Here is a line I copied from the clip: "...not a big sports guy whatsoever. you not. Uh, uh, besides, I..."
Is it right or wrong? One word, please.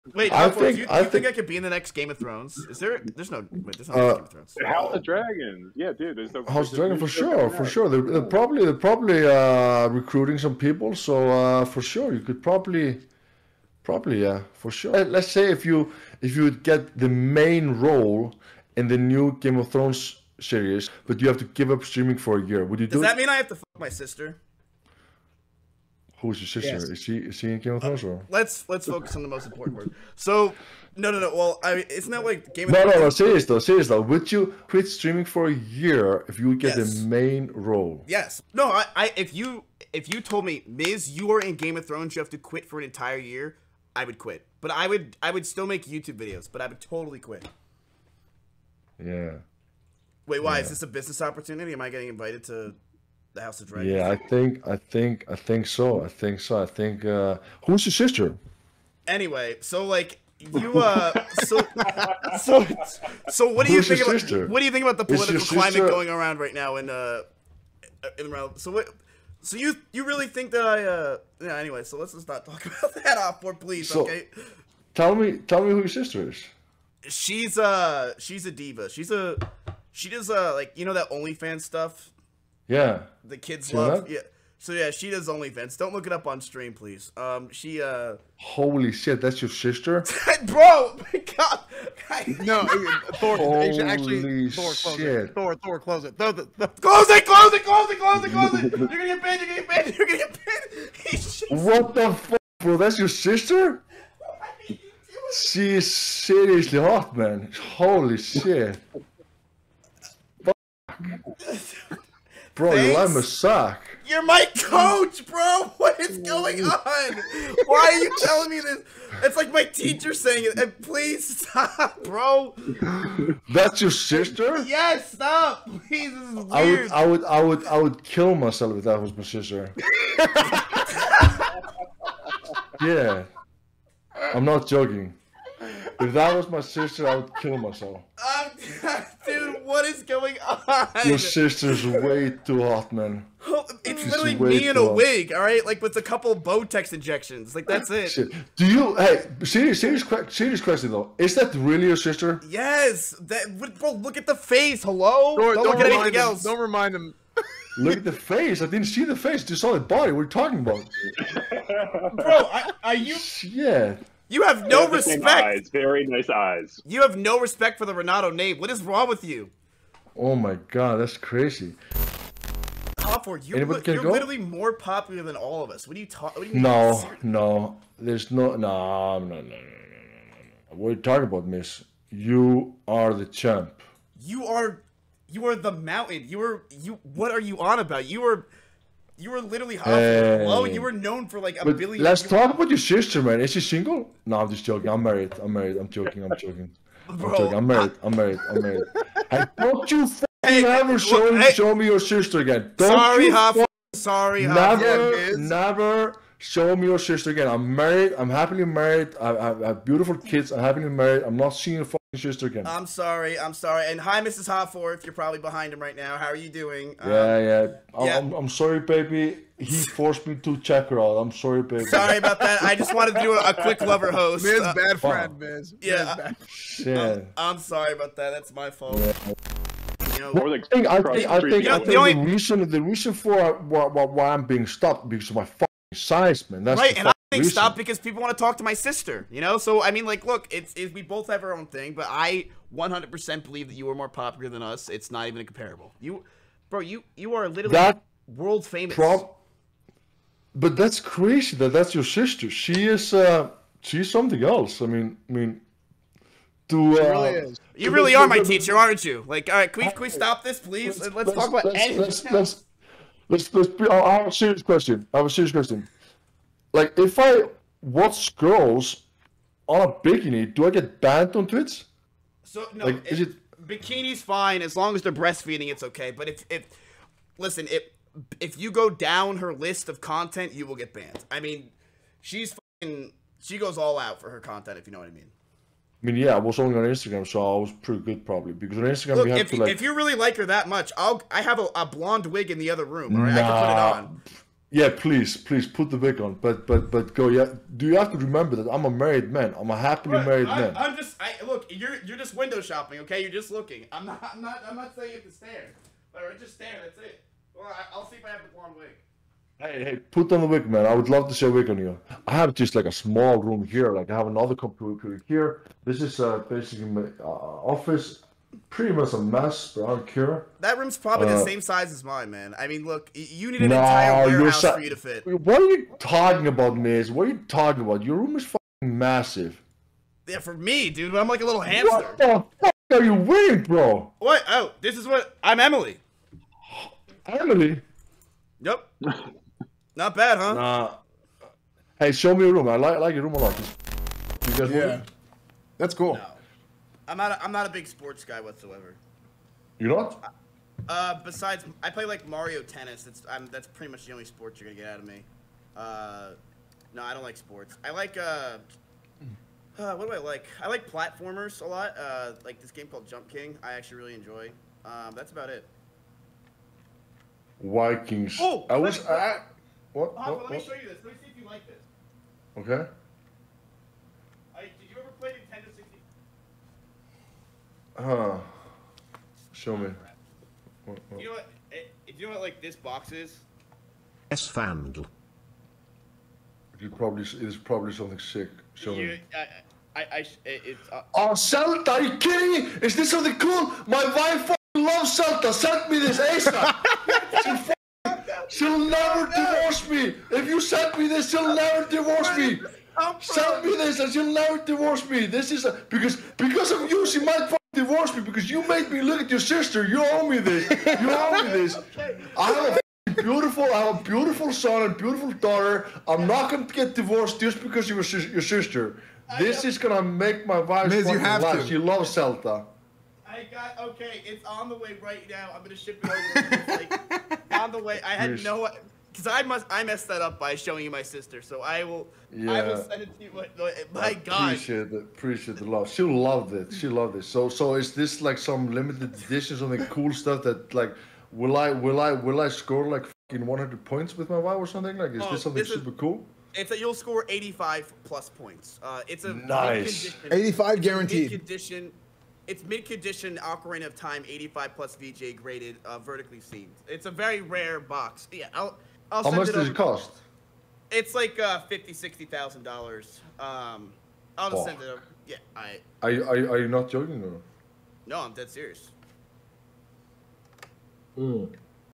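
right.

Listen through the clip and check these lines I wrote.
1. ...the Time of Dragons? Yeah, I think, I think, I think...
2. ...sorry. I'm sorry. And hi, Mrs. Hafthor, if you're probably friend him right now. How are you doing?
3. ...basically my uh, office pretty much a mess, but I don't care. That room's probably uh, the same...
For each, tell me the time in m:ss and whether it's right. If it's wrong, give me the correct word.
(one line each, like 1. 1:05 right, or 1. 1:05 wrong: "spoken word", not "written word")
1. 0:53 wrong: "House", not "Time"
2. 3:32 wrong: "behind", not "friend"
3. 5:16 right.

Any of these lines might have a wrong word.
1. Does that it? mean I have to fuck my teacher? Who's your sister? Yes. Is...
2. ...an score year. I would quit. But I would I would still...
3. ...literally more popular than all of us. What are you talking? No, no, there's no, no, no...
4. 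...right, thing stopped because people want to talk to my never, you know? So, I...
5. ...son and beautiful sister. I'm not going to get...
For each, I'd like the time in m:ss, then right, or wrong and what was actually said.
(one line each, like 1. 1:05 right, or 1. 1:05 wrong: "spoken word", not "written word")
1. 0:23 wrong: "sister", not "teacher"
2. 0:42 wrong: "entire", not "score"
3. 2:54 right
4. 3:56 wrong: "sister", not "never"
5. 6:54 wrong: "daughter", not "sister".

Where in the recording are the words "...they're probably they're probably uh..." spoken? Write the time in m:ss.
0:08.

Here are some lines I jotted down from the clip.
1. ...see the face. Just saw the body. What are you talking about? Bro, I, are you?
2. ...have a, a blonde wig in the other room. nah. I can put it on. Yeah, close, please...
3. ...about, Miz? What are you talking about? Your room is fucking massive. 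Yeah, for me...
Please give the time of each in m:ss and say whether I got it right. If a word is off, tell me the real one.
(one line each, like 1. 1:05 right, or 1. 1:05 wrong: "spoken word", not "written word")
1. 2:38 right
2. 4:51 wrong: "please", not "close"
3. 5:26 right.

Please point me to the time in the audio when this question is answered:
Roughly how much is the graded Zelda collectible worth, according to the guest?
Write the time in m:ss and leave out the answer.
7:41.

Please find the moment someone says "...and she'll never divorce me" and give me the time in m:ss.
6:43.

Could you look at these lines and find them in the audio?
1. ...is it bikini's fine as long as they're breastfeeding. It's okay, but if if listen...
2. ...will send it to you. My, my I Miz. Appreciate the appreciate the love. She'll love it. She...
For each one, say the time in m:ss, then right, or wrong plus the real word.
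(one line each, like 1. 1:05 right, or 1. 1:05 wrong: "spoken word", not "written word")
1. 4:33 right
2. 7:12 wrong: "God", not "Miz".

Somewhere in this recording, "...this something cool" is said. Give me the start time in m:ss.
6:32.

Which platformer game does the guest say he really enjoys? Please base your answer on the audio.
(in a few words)
Jump King.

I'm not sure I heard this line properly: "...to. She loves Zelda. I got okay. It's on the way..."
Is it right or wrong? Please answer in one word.
right.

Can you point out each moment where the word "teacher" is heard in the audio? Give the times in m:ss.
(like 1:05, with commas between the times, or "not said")
1:59, 4:18.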